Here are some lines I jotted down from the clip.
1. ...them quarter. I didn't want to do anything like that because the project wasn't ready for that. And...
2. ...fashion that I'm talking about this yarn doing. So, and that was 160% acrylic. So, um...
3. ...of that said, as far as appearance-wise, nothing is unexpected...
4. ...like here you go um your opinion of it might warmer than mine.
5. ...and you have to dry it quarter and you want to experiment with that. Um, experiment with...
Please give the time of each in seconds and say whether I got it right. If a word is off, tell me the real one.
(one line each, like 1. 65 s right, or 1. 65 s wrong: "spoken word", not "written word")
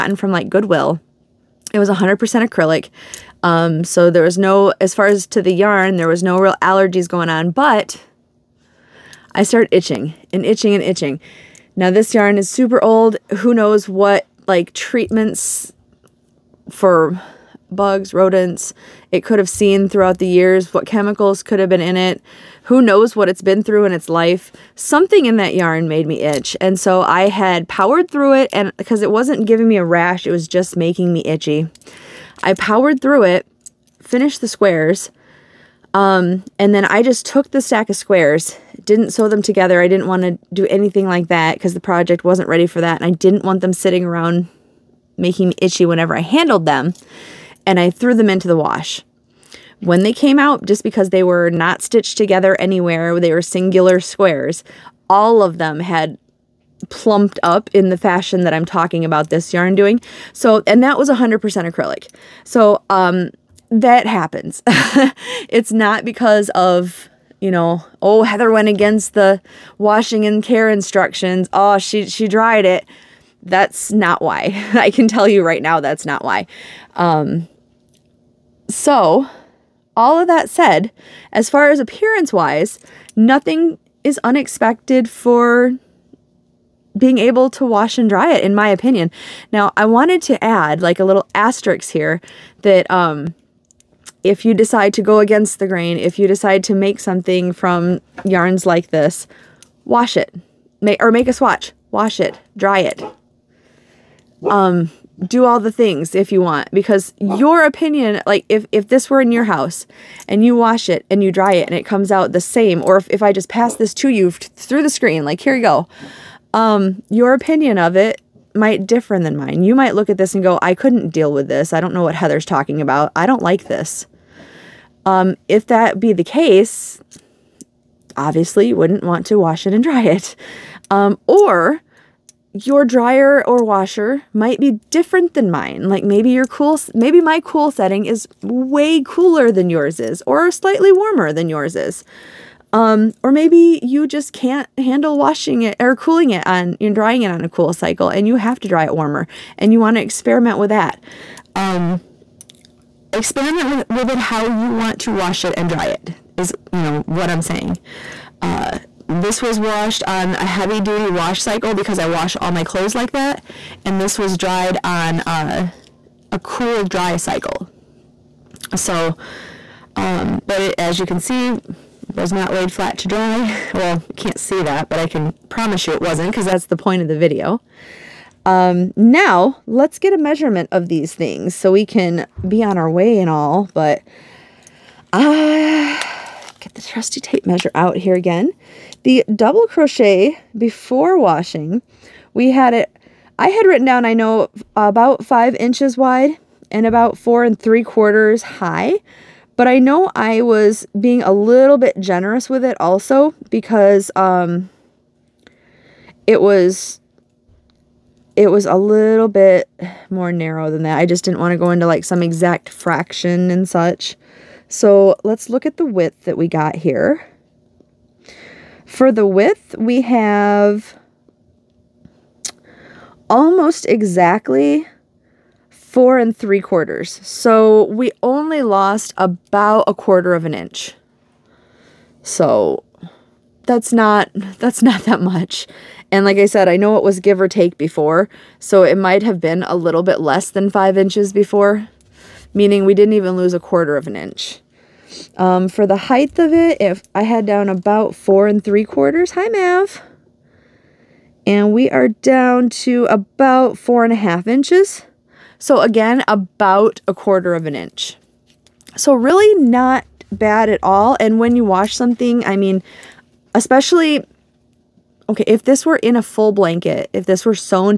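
1. 39 s wrong: "together", not "quarter"
2. 57 s wrong: "100", not "160"
3. 80 s right
4. 115 s wrong: "differ", not "warmer"
5. 148 s wrong: "warmer", not "quarter".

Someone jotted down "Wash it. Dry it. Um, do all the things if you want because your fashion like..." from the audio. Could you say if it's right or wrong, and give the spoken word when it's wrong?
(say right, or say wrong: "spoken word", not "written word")
wrong: "opinion", not "fashion".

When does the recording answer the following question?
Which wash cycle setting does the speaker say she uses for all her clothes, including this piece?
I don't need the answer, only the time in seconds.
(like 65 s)
160 s.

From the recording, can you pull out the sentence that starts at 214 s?
So let's look at the width that we got here.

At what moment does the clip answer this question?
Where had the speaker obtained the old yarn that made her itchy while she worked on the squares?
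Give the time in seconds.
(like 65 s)
0 s.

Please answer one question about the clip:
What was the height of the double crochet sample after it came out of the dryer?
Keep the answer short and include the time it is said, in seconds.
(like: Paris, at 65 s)
4 1/2 inches, at 253 s.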